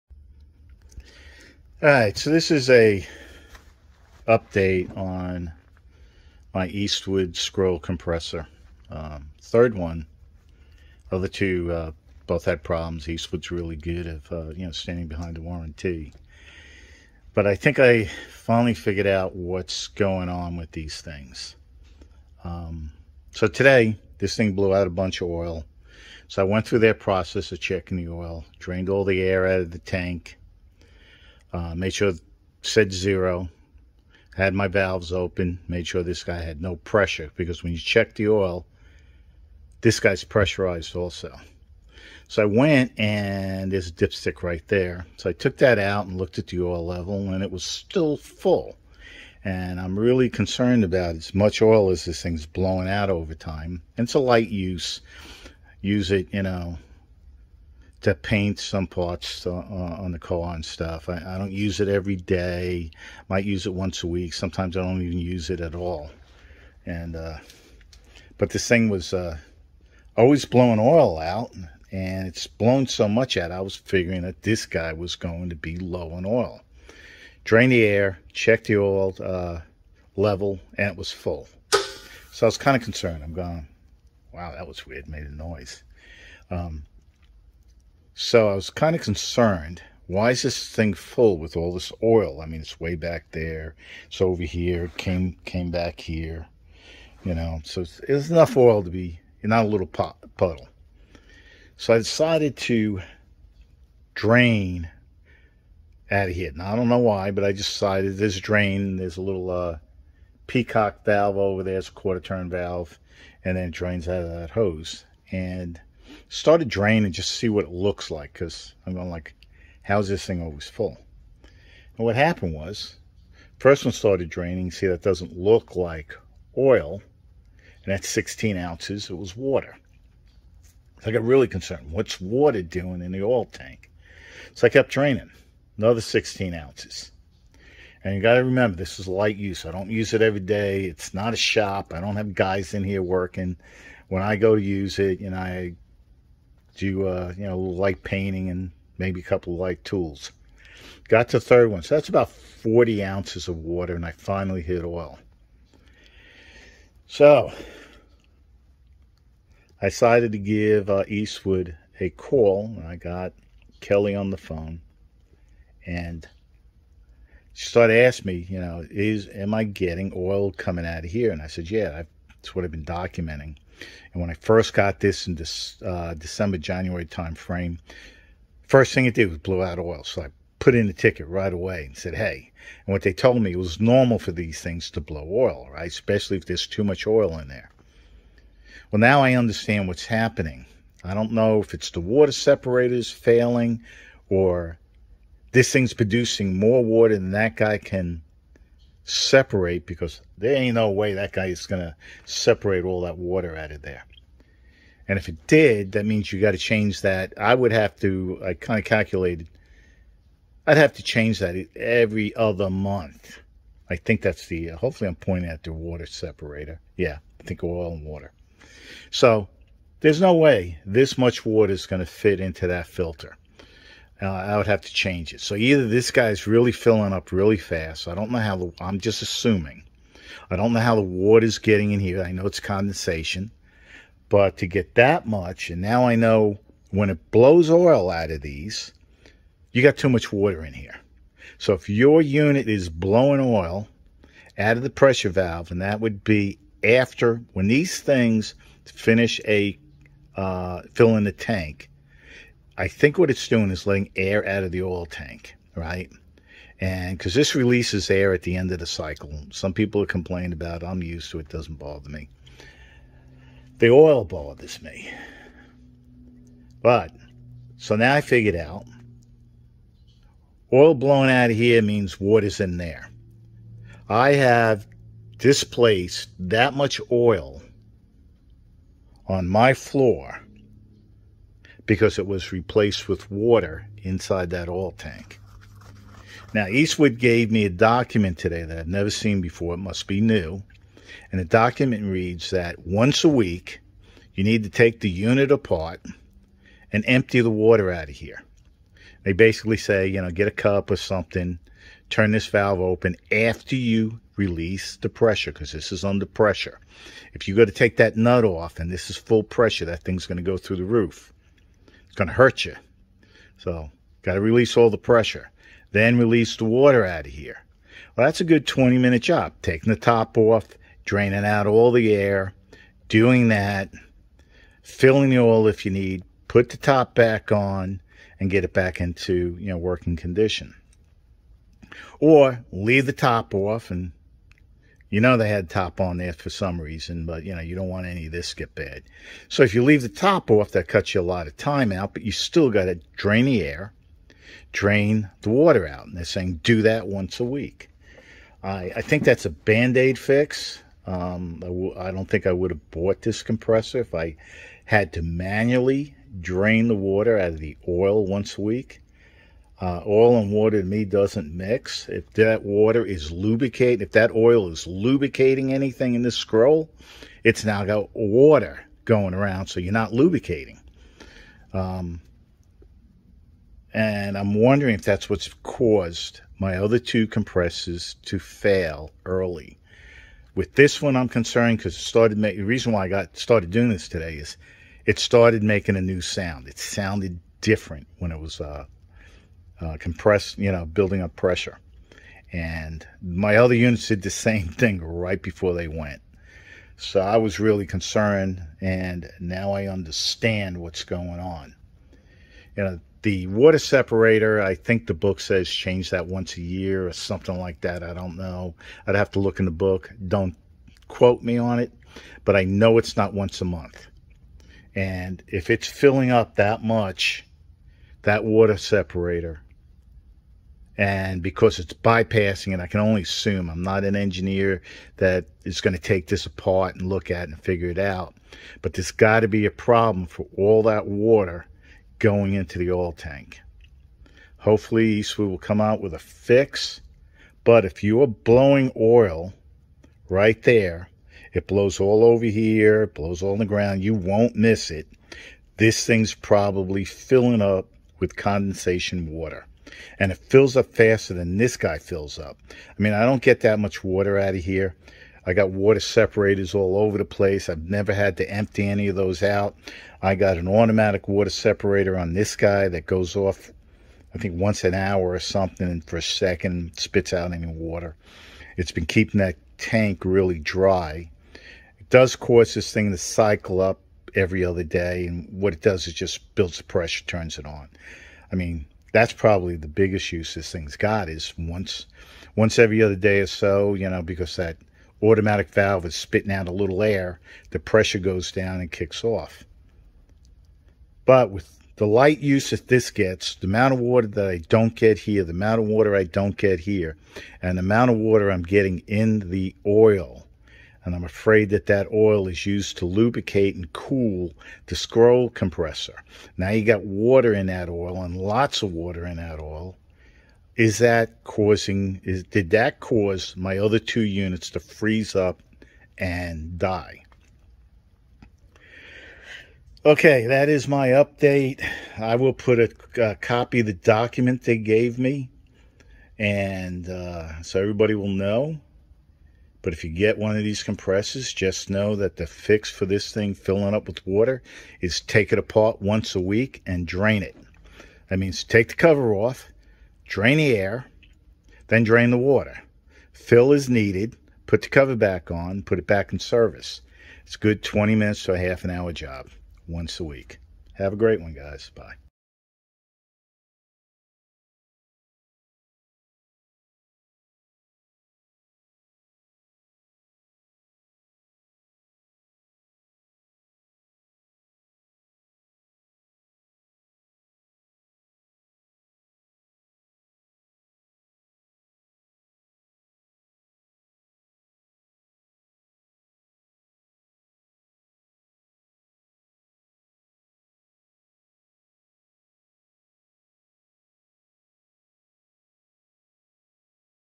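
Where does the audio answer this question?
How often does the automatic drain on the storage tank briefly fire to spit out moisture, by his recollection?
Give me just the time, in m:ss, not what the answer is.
7:44.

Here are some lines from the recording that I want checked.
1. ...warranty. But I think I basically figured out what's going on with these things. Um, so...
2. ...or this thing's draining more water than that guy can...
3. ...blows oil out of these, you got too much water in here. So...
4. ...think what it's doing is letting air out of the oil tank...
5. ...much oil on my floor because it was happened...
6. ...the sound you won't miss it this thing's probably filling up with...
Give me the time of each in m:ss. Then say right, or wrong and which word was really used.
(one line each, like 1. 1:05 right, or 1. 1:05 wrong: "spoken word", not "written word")
1. 0:15 wrong: "finally", not "basically"
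2. 3:14 wrong: "producing", not "draining"
3. 3:57 right
4. 4:12 right
5. 4:36 wrong: "replaced", not "happened"
6. 7:23 wrong: "ground", not "sound".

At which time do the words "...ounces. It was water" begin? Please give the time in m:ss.
2:08.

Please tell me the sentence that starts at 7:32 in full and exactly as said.
I mean, I don't get that much water out of here.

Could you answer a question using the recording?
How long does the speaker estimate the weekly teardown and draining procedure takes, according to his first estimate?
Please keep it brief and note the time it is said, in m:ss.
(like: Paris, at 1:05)
20 minutes, at 5:18.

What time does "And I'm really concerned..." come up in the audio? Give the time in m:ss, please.
0:49.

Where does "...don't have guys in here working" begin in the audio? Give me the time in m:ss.
2:22.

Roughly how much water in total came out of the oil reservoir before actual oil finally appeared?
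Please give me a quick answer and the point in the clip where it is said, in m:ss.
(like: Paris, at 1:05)
40 ounces, at 2:32.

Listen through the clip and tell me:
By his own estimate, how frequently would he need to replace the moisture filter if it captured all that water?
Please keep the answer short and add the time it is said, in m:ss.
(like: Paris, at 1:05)
every other month, at 3:31.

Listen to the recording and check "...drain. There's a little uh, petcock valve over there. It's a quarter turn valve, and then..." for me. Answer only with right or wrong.
right.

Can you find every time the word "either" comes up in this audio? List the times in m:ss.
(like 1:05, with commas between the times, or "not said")
3:45.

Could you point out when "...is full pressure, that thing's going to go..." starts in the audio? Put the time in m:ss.
5:09.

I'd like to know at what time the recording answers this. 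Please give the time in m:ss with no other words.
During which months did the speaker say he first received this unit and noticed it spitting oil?
2:56.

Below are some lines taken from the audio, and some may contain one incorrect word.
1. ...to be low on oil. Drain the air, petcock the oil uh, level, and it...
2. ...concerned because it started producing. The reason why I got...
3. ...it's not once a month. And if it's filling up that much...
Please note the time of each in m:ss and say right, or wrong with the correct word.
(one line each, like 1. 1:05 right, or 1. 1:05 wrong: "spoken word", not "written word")
1. 1:15 wrong: "check", not "petcock"
2. 6:21 wrong: "making", not "producing"
3. 6:52 right.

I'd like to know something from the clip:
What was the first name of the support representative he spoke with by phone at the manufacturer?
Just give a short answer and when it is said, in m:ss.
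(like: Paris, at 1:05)
Kelly, at 2:43.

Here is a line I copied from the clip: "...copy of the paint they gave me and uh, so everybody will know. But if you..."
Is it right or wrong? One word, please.
wrong.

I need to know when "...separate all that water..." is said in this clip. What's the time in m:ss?
3:22.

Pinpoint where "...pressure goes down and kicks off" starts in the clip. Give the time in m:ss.
8:07.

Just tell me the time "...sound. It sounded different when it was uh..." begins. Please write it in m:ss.
6:26.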